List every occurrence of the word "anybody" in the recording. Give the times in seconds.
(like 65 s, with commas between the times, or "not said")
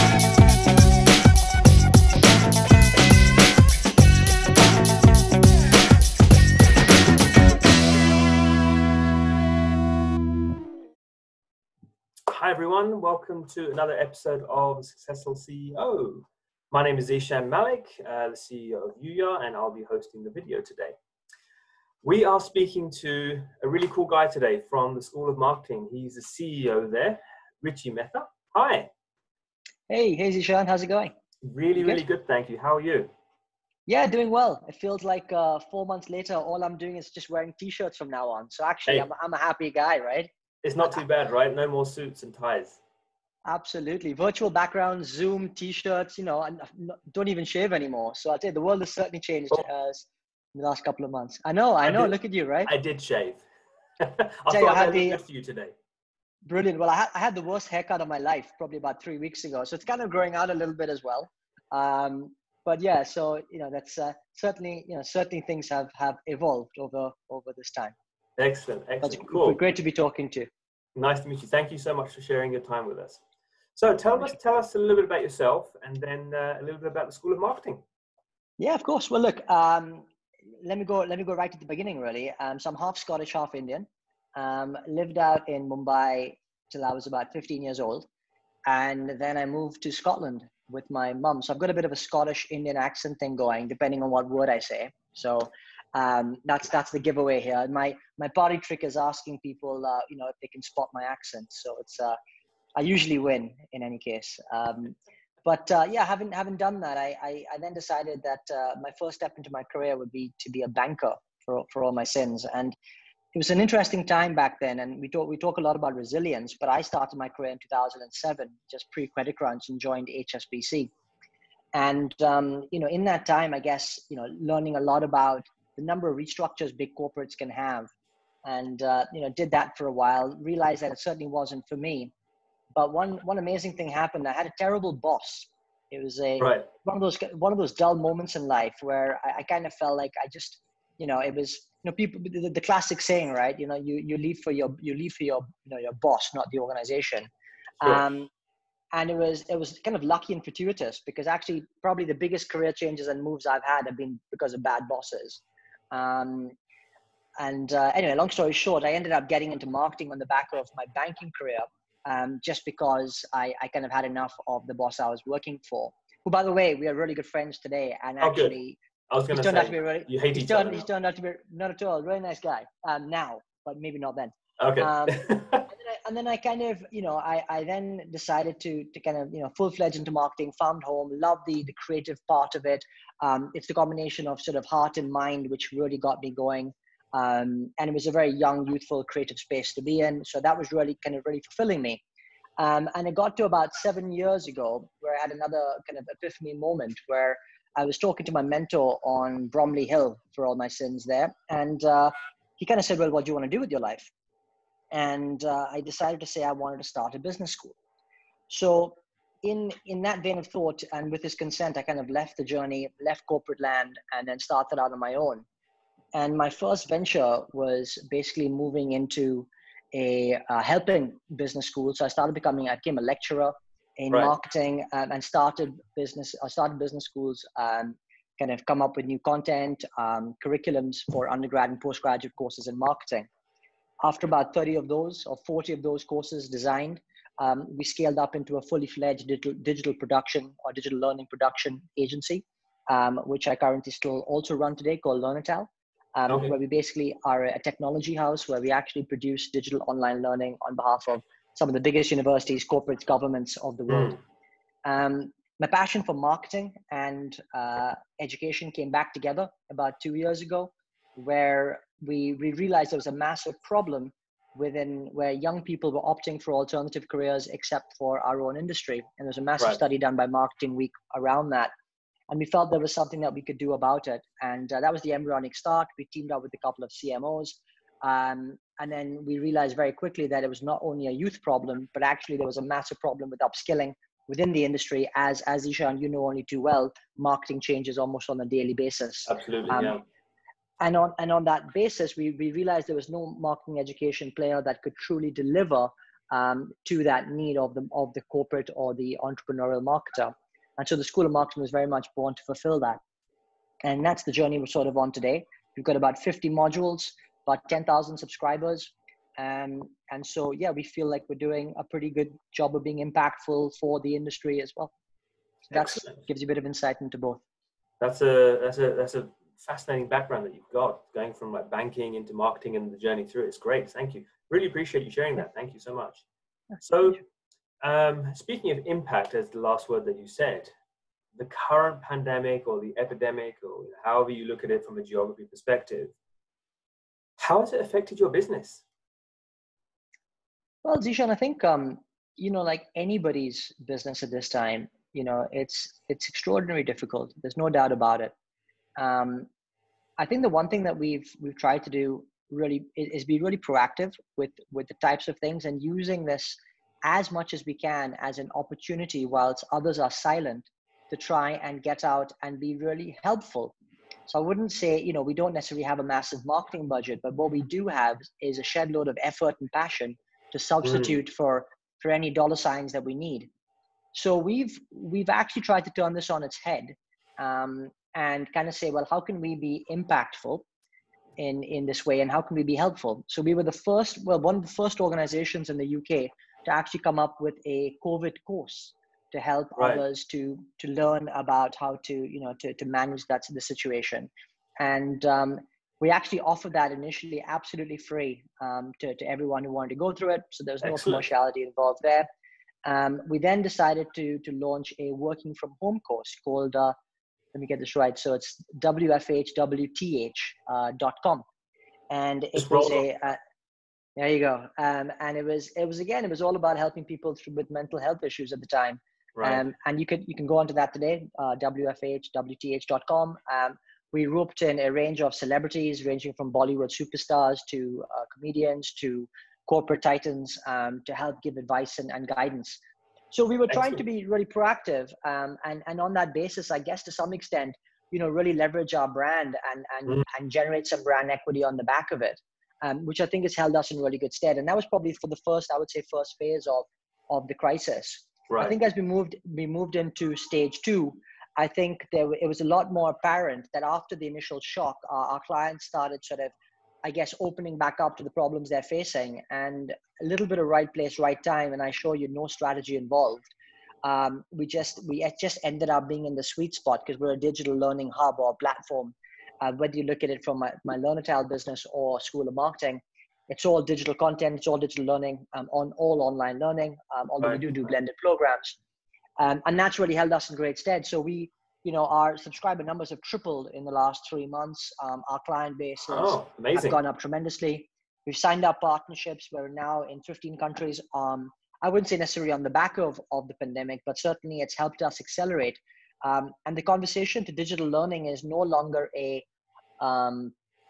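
342 s.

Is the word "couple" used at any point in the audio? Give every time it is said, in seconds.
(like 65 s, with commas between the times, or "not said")
50 s, 276 s.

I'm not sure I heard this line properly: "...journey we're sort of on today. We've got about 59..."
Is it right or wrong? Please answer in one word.
wrong.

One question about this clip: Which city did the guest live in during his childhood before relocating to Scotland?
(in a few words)
Mumbai.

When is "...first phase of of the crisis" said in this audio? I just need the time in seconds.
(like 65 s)
446 s.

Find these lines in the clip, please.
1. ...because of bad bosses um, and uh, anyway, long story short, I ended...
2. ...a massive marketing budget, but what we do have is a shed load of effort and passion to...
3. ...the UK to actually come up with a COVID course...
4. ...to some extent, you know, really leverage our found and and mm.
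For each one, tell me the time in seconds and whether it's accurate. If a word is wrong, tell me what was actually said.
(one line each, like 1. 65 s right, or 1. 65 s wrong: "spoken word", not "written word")
1. 154 s right
2. 365 s right
3. 385 s right
4. 437 s wrong: "brand", not "found".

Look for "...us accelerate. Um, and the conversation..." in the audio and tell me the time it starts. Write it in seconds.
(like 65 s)
495 s.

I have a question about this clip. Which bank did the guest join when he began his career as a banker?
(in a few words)
HSBC.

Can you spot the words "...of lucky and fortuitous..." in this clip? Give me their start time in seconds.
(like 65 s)
149 s.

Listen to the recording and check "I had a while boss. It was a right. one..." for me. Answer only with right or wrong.
wrong.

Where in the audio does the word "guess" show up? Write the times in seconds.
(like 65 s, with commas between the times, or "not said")
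123 s, 436 s, 457 s.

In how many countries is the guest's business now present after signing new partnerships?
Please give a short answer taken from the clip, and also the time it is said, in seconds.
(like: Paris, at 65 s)
15, at 490 s.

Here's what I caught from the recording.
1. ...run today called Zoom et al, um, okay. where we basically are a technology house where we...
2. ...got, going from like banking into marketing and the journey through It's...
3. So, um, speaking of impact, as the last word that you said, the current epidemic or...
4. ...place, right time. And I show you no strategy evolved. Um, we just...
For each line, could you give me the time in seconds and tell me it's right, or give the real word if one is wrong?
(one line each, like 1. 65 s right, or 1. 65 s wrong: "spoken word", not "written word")
1. 244 s wrong: "Learn", not "Zoom"
2. 320 s right
3. 326 s wrong: "pandemic", not "epidemic"
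4. 460 s wrong: "involved", not "evolved".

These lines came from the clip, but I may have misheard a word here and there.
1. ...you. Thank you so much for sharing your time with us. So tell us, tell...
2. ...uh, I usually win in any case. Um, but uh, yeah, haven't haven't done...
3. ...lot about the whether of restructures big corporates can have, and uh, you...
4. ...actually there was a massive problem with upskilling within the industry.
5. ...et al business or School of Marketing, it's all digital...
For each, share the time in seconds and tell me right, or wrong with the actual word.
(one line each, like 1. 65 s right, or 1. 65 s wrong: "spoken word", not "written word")
1. 71 s right
2. 101 s right
3. 124 s wrong: "number", not "whether"
4. 282 s right
5. 471 s right.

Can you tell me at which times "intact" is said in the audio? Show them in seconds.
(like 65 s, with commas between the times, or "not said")
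not said.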